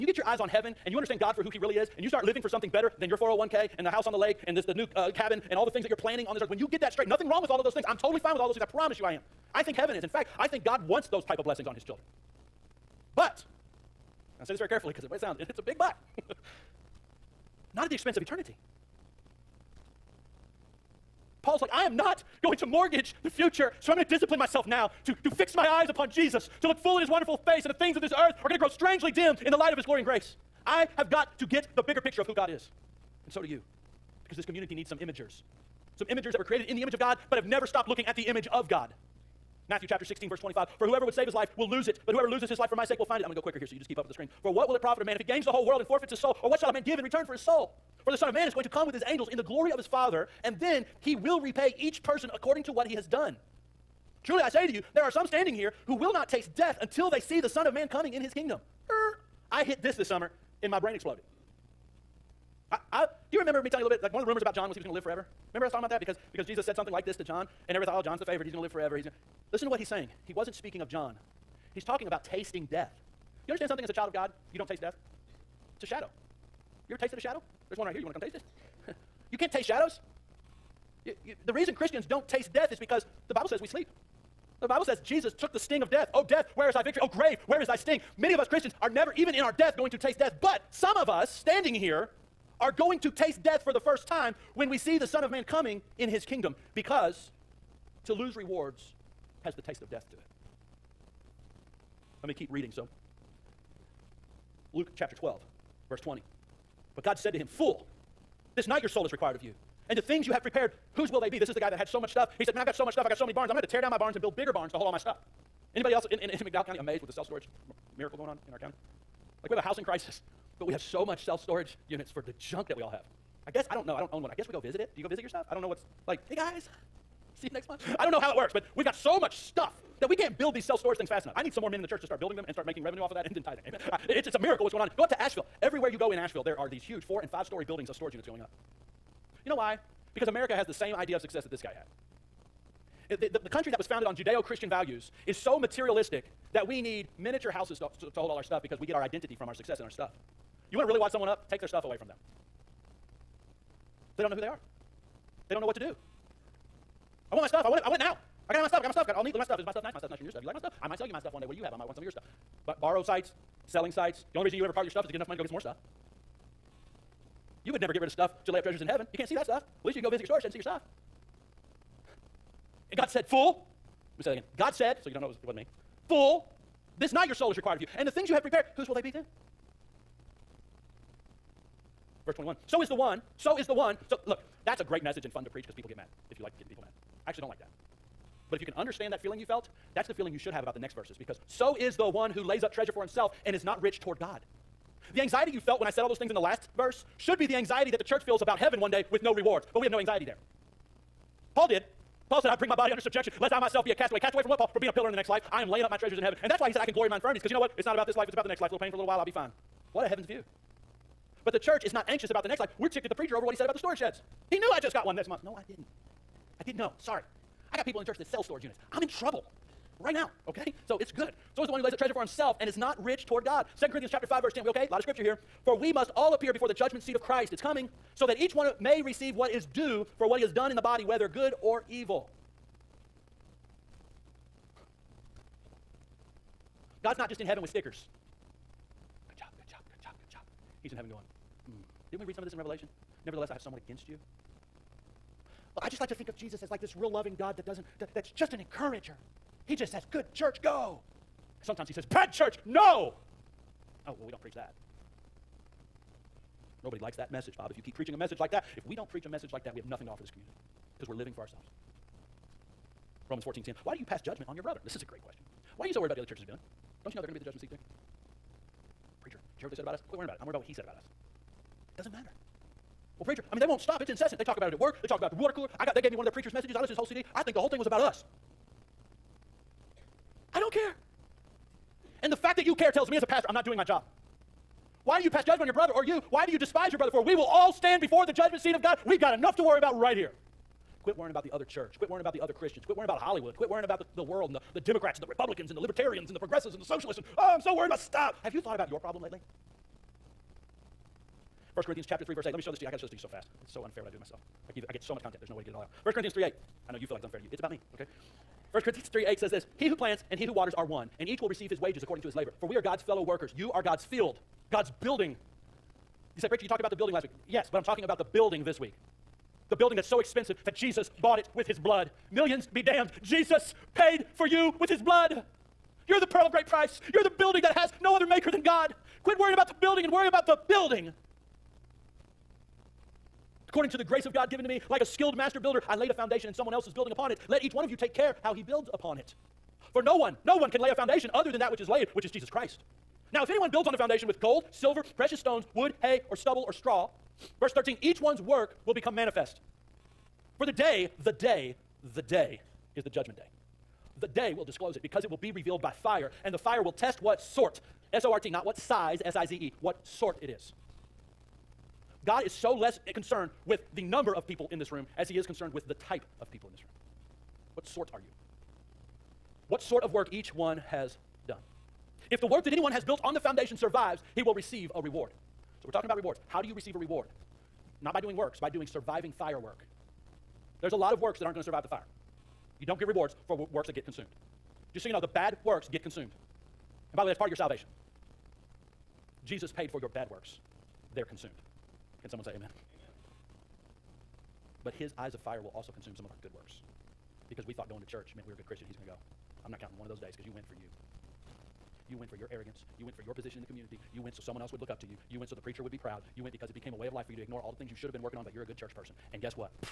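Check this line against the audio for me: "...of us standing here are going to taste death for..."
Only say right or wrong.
right.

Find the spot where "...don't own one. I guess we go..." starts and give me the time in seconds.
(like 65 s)
123 s.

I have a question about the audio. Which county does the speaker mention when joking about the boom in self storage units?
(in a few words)
McDowell County.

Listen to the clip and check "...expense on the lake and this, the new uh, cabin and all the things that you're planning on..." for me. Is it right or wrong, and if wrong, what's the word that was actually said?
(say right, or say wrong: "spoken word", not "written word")
wrong: "house", not "expense".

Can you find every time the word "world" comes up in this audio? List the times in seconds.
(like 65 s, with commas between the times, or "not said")
45 s, 294 s.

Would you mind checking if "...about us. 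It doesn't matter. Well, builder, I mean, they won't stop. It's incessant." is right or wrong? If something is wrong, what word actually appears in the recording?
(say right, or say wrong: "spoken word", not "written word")
wrong: "preacher", not "builder".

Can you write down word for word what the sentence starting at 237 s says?
God's not just in heaven with stickers.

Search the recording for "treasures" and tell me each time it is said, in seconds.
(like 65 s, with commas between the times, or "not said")
168 s, 192 s, 205 s, 221 s.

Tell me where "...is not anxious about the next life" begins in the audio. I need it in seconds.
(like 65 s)
211 s.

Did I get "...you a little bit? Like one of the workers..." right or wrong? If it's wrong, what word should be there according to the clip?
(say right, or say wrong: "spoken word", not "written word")
wrong: "rumors", not "workers".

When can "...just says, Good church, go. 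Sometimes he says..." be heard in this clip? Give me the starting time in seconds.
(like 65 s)
249 s.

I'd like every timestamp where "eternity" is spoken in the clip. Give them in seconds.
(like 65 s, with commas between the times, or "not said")
18 s.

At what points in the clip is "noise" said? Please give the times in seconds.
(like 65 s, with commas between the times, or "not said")
not said.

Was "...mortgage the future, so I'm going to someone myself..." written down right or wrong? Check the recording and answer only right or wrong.
wrong.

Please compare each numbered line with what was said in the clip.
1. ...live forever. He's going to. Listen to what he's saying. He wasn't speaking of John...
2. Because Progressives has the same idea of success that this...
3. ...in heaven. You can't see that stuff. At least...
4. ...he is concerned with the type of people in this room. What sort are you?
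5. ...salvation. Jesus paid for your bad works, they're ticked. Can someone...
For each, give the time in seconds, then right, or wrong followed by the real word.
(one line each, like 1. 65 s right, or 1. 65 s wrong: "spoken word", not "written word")
1. 68 s right
2. 140 s wrong: "America", not "Progressives"
3. 168 s right
4. 365 s right
5. 387 s wrong: "consumed", not "ticked".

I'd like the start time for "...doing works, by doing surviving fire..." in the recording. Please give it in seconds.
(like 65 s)
378 s.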